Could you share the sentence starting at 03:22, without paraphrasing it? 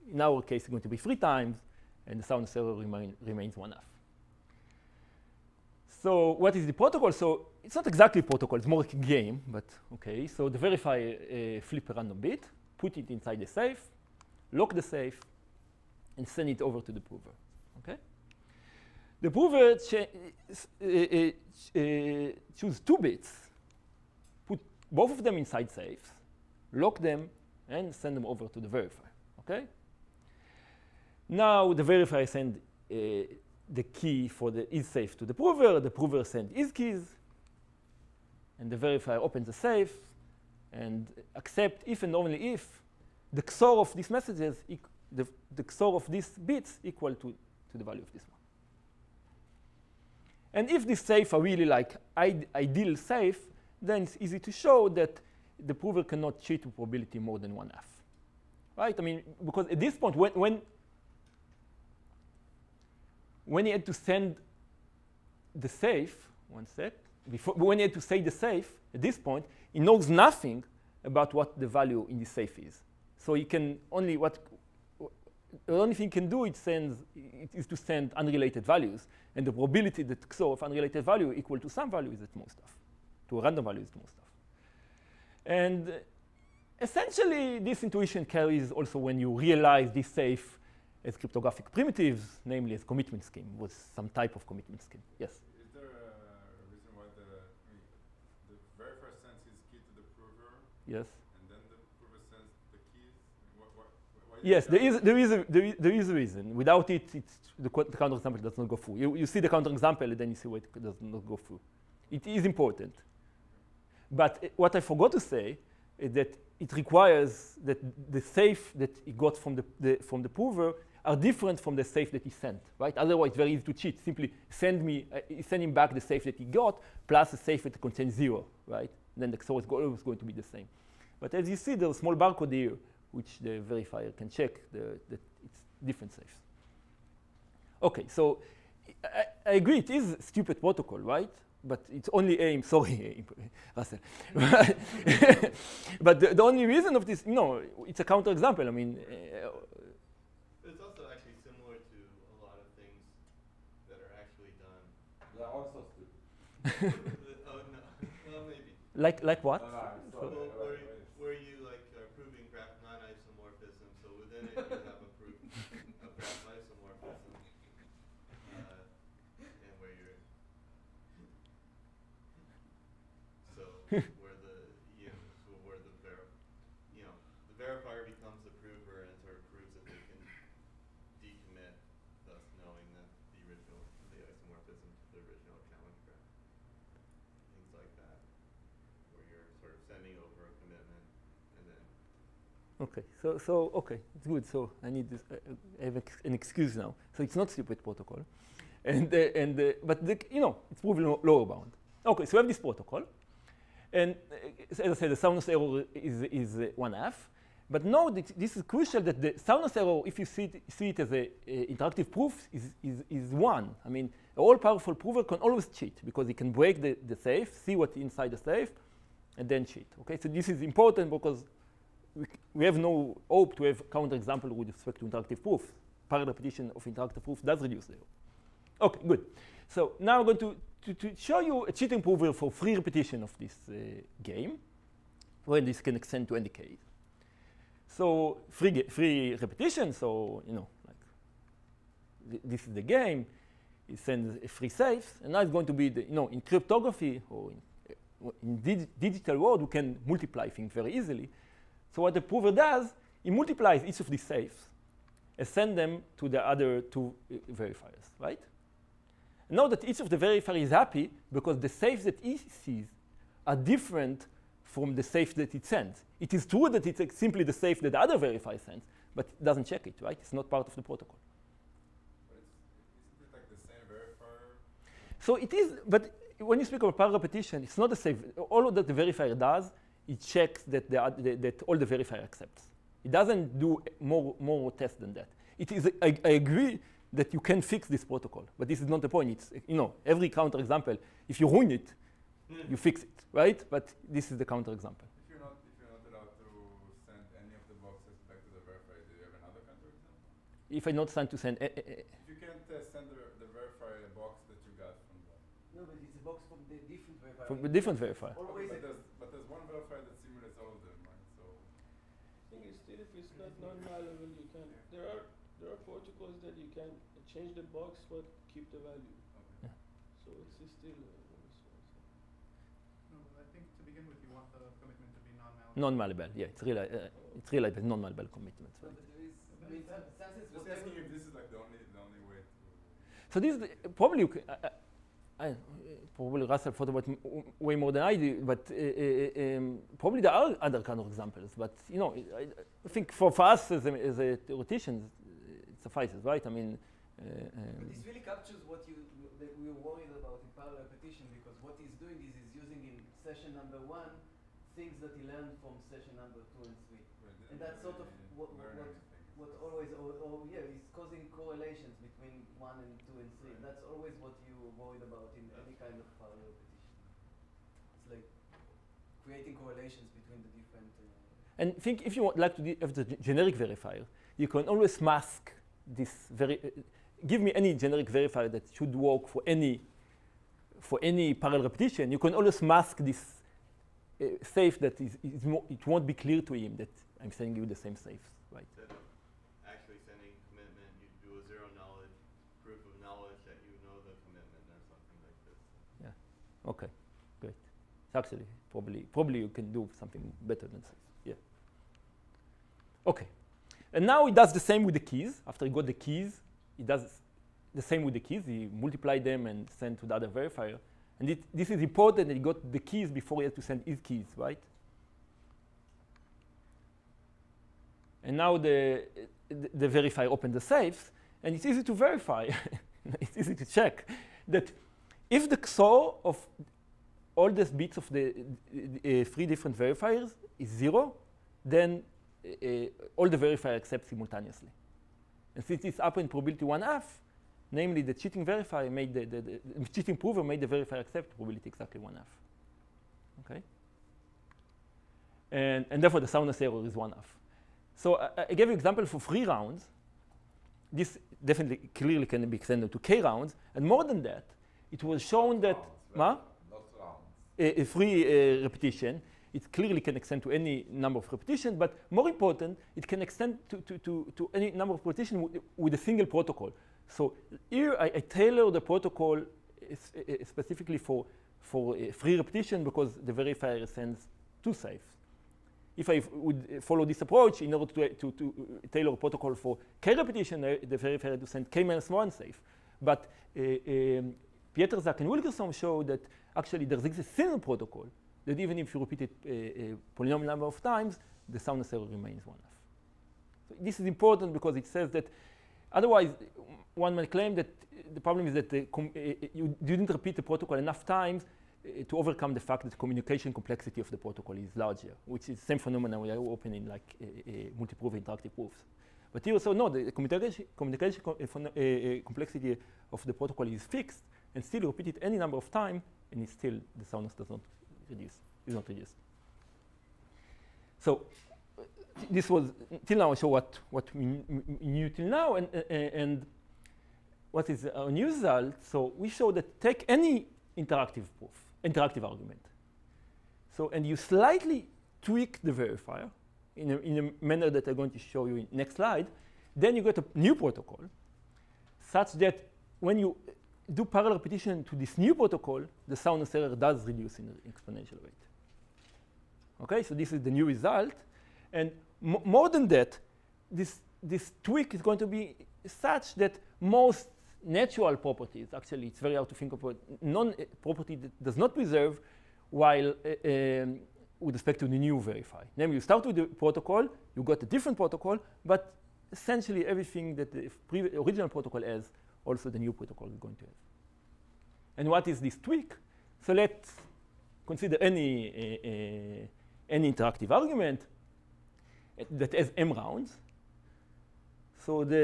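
Okay, so we have this protocol.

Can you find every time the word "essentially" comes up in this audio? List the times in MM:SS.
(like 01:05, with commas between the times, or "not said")
01:26, 09:29.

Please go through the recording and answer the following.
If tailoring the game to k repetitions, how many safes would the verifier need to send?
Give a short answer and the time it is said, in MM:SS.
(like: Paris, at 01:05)
k minus one, at 08:01.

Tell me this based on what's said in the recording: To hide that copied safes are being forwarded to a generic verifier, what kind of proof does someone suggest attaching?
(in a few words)
Zero knowledge proof of knowledge.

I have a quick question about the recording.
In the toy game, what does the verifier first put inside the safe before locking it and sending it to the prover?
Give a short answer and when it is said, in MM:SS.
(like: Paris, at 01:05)
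A random bit, at 00:11.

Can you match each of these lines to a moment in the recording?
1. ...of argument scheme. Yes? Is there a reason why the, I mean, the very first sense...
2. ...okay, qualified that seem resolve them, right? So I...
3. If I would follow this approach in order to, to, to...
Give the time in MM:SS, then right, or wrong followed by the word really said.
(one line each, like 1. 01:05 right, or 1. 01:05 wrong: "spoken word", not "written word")
1. 01:34 wrong: "commitment", not "argument"
2. 05:08 right
3. 07:55 right.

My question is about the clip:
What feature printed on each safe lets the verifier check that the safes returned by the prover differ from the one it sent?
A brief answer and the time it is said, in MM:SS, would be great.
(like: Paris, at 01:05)
Barcode, at 02:12.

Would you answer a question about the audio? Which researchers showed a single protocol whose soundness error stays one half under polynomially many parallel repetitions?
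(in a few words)
Pietrzak and Wikström.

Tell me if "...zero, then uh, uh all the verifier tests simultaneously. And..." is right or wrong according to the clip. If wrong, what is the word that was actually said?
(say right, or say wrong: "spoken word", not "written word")
wrong: "accepts", not "tests".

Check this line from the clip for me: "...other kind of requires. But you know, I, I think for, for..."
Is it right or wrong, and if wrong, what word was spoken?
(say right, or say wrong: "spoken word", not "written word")
wrong: "examples", not "requires".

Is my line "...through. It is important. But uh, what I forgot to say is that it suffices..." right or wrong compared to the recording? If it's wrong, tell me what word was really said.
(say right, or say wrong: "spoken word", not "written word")
wrong: "requires", not "suffices".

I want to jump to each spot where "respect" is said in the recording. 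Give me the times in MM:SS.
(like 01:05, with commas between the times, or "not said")
03:44, 09:24.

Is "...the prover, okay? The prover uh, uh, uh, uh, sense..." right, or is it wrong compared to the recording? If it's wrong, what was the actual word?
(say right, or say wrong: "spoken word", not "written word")
wrong: "choose", not "sense".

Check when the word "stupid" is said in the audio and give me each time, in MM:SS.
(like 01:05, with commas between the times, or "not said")
02:20, 03:17.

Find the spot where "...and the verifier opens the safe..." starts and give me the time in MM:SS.
00:38.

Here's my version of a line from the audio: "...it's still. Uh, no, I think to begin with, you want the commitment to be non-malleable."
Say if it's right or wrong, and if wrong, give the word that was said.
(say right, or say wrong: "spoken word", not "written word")
right.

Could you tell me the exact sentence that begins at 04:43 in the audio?
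It doesn't do more, more tests than that.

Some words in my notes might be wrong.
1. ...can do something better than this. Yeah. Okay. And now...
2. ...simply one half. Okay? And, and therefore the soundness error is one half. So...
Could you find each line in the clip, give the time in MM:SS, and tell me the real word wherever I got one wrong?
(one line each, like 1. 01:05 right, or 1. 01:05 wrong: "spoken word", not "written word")
1. 06:39 right
2. 07:21 wrong: "exactly", not "simply".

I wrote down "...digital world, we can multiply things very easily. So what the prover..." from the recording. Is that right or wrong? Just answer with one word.
right.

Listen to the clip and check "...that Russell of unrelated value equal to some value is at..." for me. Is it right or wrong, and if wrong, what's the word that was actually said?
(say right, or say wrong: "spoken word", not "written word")
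wrong: "XOR", not "Russell".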